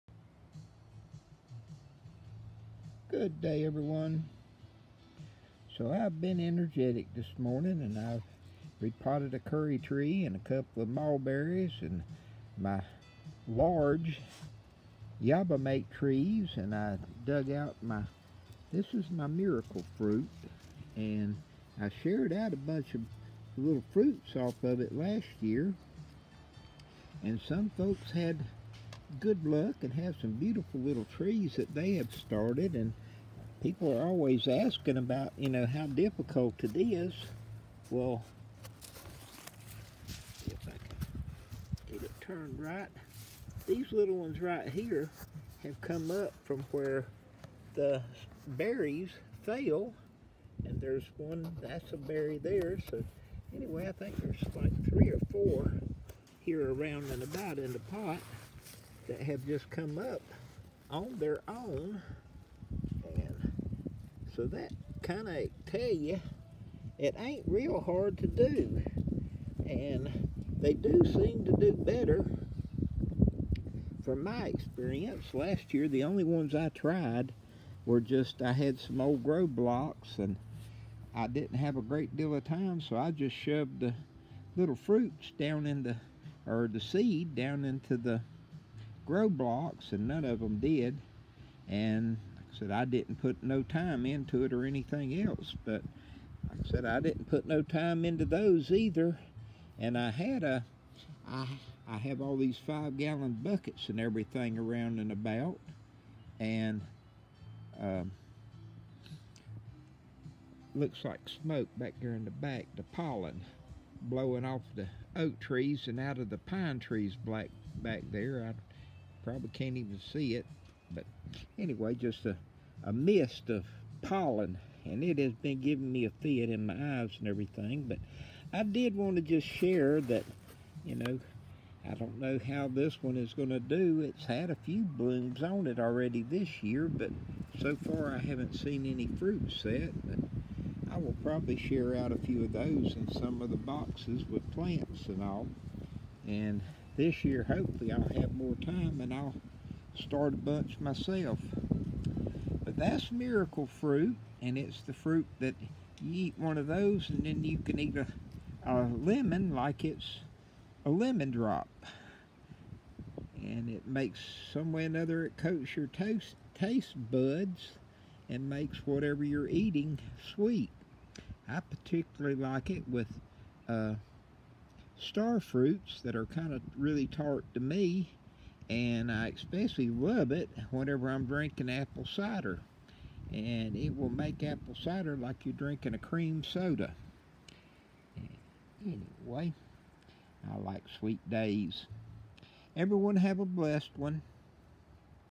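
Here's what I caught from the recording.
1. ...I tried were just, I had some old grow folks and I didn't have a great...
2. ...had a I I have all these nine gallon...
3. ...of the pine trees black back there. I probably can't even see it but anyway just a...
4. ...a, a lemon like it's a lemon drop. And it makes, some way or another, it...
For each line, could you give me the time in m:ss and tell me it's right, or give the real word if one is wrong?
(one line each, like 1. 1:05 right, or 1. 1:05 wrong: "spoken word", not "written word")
1. 1:16 wrong: "blocks", not "folks"
2. 1:40 wrong: "five", not "nine"
3. 1:56 right
4. 2:37 right.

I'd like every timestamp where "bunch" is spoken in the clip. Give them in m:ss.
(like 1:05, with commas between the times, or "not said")
0:22, 2:30.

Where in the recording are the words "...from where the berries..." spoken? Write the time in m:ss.
0:46.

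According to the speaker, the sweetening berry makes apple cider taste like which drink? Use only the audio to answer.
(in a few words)
cream soda.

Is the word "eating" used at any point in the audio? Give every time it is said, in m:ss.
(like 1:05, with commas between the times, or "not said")
2:49.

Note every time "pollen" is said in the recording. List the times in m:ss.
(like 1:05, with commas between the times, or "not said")
1:52, 2:04.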